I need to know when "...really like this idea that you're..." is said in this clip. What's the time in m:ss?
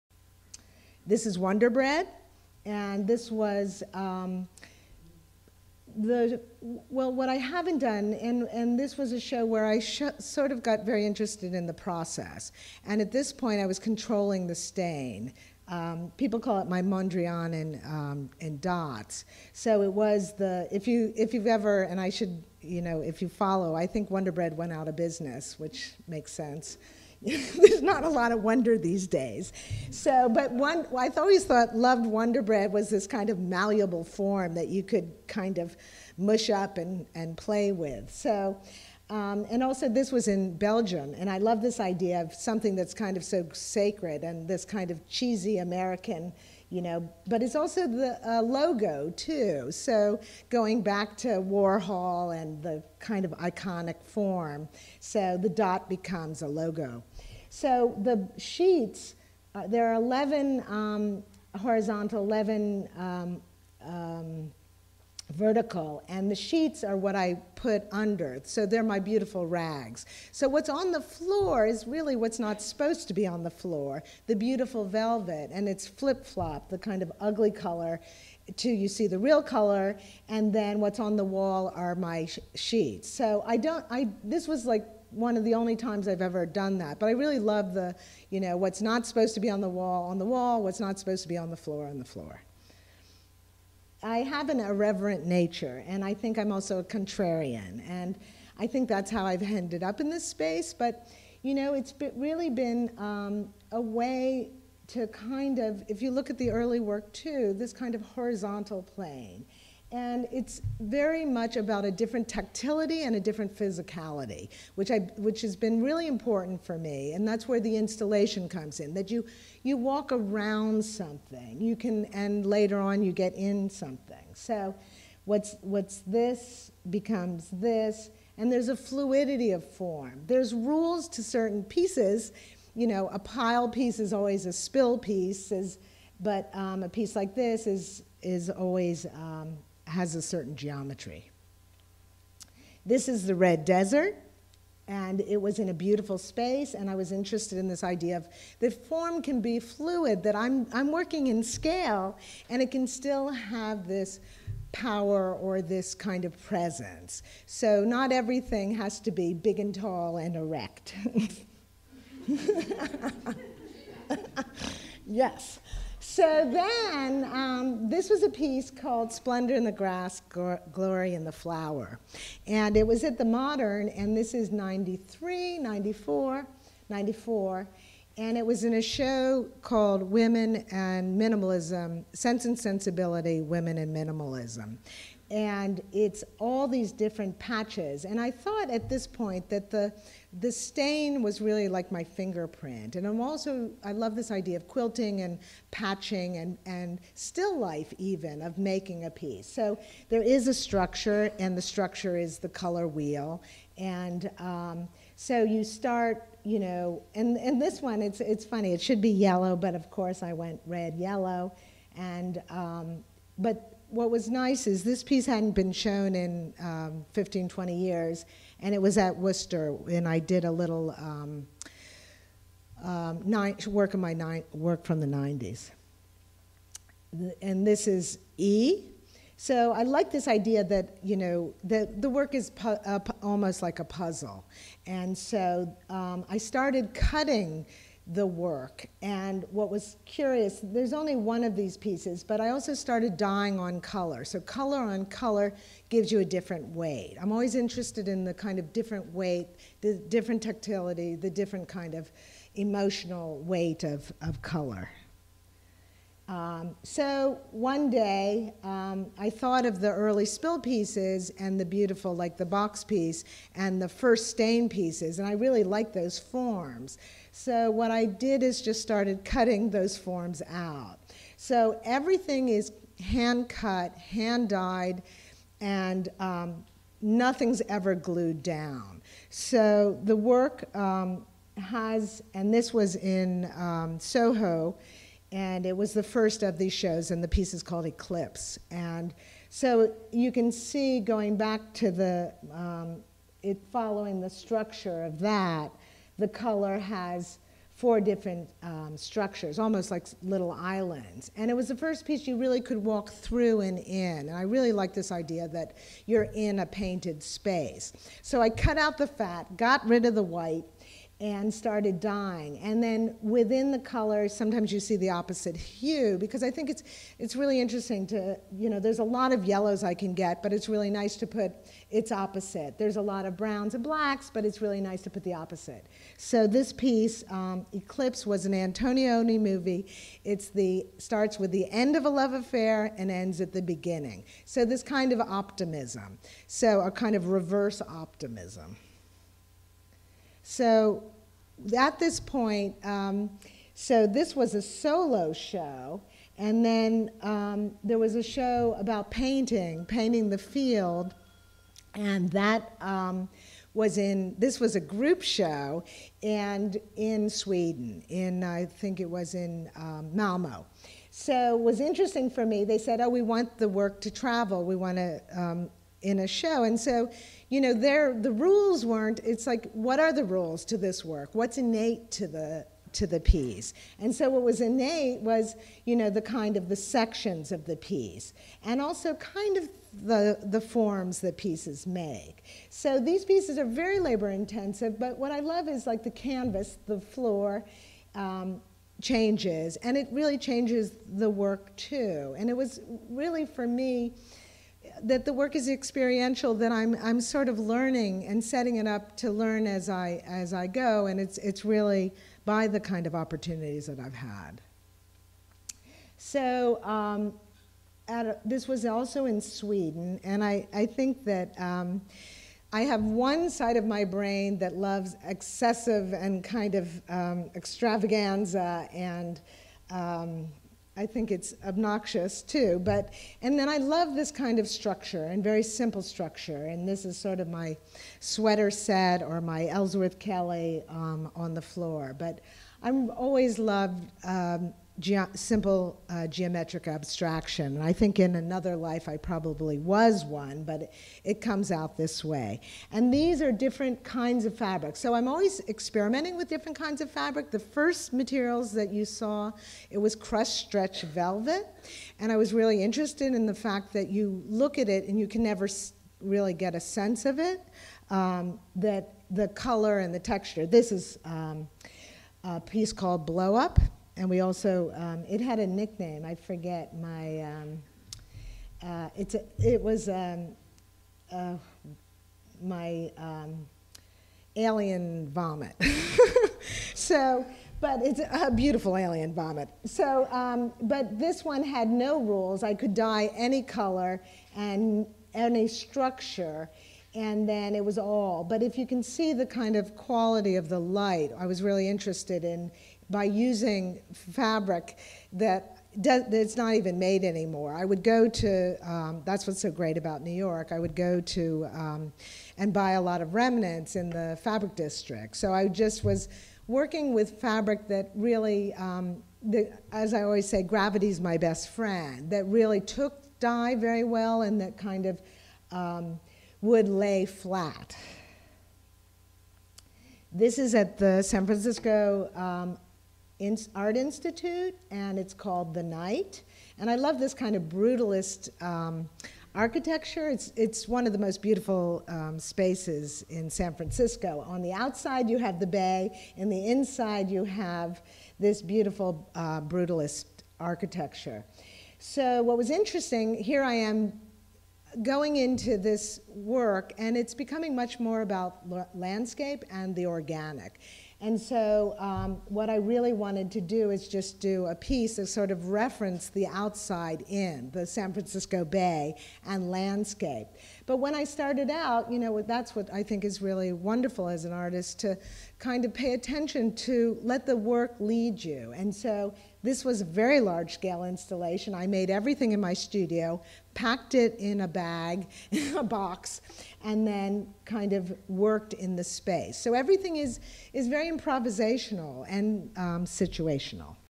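5:04.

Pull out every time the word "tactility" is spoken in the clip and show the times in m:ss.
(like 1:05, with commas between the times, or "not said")
1:52, 4:10.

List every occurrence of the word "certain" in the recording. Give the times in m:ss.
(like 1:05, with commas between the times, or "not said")
2:11, 2:20.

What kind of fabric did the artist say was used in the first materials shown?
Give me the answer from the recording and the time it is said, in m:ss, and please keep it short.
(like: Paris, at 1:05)
crushed stretch velvet, at 7:30.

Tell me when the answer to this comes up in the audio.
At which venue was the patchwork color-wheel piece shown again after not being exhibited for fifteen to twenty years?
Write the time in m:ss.
3:39.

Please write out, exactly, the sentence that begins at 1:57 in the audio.
And that's where the installation comes in, that you, you walk around something.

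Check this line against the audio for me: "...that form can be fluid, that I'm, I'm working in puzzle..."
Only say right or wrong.
wrong.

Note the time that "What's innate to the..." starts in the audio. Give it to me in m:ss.
6:11.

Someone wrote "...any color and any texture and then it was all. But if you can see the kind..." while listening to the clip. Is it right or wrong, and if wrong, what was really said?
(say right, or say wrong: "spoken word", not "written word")
wrong: "structure", not "texture".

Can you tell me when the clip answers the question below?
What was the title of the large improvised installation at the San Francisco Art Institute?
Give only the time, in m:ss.
8:45.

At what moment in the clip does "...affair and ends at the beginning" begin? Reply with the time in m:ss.
5:32.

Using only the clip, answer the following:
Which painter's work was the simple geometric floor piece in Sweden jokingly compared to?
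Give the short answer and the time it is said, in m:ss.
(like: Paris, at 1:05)
Ellsworth Kelly, at 7:09.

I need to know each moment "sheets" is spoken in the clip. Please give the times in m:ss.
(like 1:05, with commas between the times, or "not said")
0:58, 1:06, 1:22.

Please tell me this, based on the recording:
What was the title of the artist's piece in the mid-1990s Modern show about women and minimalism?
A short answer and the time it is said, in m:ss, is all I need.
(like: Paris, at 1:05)
Splendor in the Grass, Glory in the Flower, at 2:49.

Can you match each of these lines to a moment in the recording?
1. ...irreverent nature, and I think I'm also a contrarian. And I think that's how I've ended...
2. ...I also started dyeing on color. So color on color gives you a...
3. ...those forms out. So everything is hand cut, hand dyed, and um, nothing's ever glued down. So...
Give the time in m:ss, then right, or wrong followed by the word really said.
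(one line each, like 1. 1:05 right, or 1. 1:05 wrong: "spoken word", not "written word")
1. 1:34 right
2. 4:02 right
3. 4:29 right.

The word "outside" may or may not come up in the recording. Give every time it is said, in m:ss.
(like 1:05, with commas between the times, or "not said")
8:54, 9:16.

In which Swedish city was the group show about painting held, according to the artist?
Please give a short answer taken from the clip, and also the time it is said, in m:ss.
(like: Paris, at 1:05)
Malmo, at 6:00.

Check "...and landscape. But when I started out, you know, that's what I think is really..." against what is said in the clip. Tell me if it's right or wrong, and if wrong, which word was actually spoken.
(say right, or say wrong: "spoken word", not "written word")
right.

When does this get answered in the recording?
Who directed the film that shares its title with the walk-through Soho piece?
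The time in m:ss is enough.
5:28.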